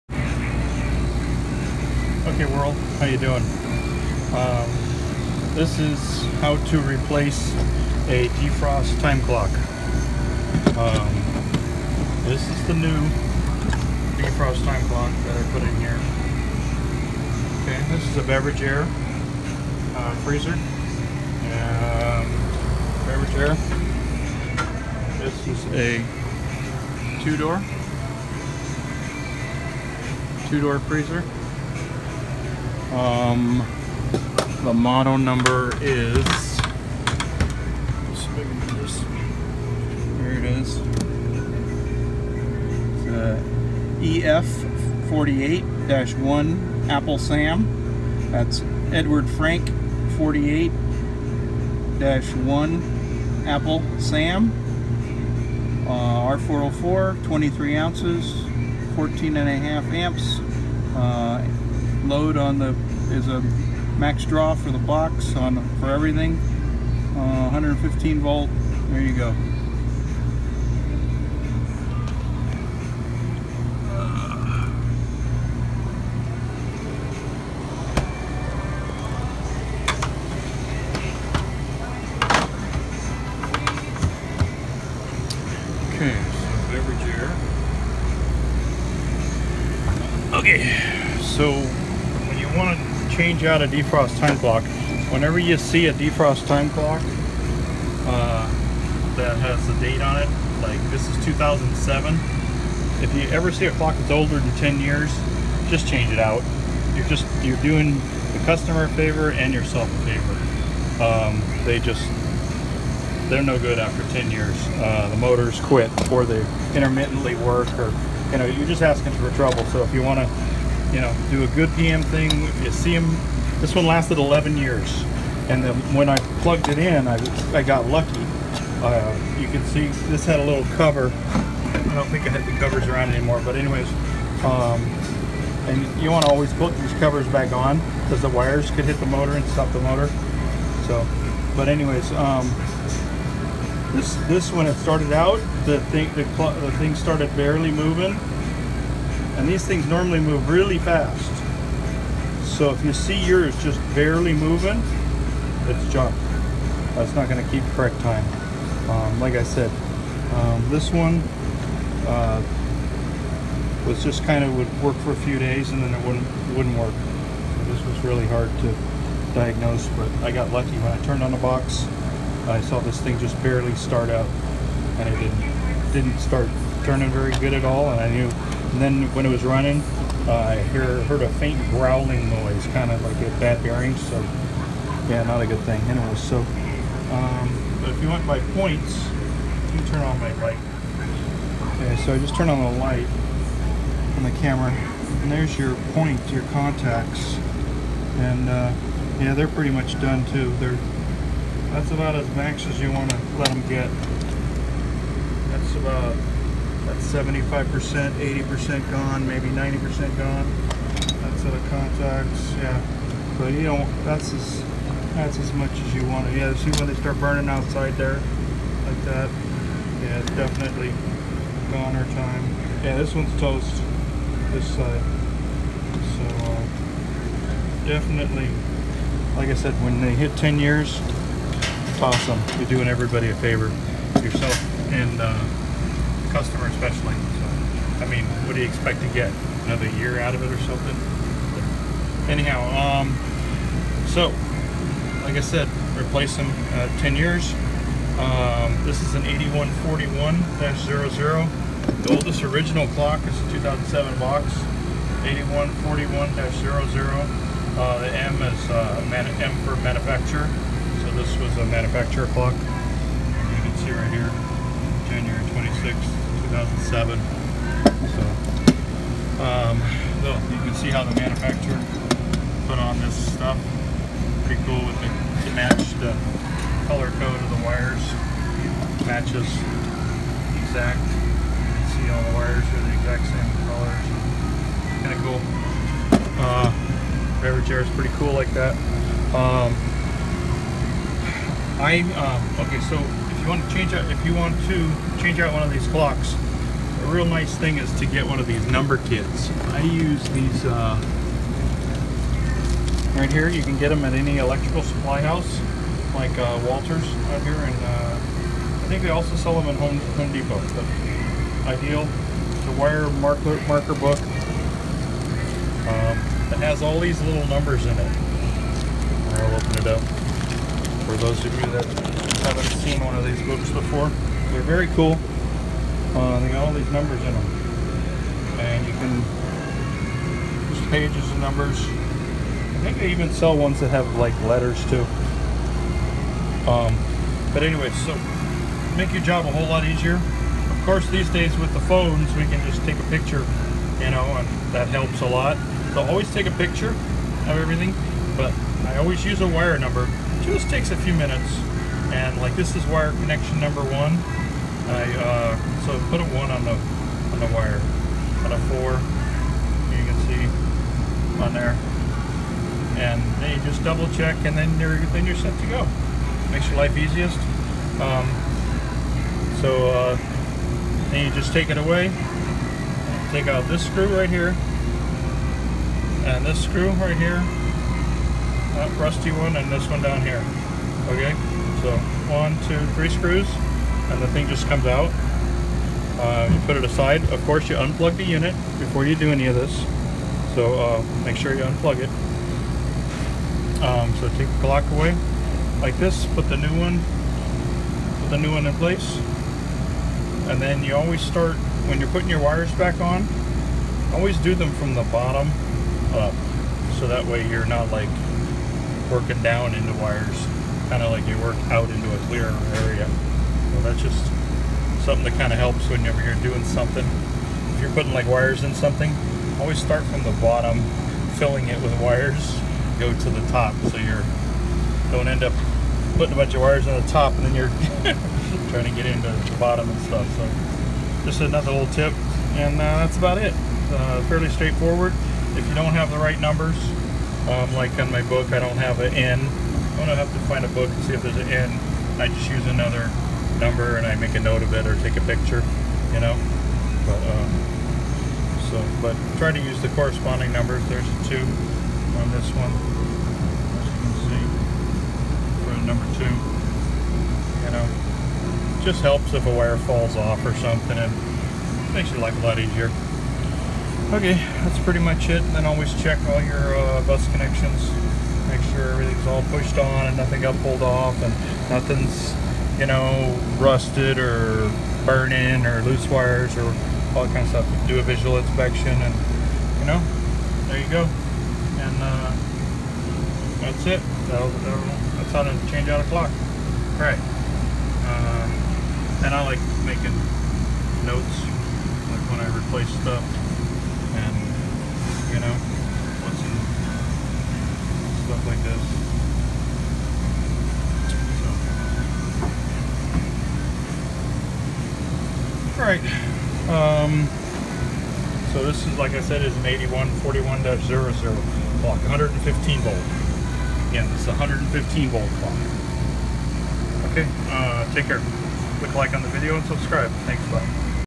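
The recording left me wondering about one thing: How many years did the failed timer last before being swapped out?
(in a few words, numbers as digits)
11 years.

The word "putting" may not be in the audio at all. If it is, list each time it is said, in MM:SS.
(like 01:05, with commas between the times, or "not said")
06:42, 06:57, 07:06.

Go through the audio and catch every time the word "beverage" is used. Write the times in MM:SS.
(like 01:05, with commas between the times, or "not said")
00:18, 00:23, 01:26, 04:47.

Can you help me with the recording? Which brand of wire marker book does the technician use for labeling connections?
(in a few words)
Ideal.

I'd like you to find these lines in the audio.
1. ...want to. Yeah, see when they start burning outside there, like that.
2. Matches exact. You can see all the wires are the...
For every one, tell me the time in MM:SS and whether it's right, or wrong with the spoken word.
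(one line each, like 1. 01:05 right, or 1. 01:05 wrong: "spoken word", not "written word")
1. 03:36 right
2. 04:39 right.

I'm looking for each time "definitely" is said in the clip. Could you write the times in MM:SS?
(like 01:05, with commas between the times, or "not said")
03:40, 03:47.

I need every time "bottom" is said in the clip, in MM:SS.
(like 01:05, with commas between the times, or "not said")
06:45, 07:00, 07:09.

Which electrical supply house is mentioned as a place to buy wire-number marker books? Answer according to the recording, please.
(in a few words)
Walters.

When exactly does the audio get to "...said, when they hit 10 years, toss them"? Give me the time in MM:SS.
03:49.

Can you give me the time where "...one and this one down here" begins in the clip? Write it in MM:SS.
06:19.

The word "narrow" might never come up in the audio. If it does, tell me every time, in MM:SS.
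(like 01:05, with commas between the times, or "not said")
not said.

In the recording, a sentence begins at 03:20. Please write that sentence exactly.
They're that's about as max as you want to let them get.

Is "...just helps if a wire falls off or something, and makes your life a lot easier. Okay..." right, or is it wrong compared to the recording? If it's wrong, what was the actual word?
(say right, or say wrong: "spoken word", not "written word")
right.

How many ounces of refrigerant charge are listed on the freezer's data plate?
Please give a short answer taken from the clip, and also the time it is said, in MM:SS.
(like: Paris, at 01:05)
23 ounces, at 00:57.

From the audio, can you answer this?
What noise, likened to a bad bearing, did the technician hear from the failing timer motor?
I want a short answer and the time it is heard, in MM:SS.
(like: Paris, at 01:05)
faint growling noise, at 03:01.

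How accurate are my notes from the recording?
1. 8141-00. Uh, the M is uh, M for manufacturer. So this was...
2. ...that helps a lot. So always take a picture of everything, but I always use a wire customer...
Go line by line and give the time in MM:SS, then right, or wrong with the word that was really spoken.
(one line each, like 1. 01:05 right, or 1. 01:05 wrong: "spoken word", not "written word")
1. 04:15 right
2. 05:44 wrong: "number", not "customer".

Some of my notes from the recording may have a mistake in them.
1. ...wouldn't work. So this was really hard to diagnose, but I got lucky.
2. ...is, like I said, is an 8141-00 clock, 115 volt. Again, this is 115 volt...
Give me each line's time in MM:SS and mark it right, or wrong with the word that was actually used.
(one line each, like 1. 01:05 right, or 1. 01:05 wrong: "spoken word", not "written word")
1. 02:46 right
2. 08:28 right.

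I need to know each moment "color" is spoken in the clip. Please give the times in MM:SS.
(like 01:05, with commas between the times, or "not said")
04:36, 04:43.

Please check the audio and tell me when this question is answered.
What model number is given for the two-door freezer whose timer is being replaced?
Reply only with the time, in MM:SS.
00:44.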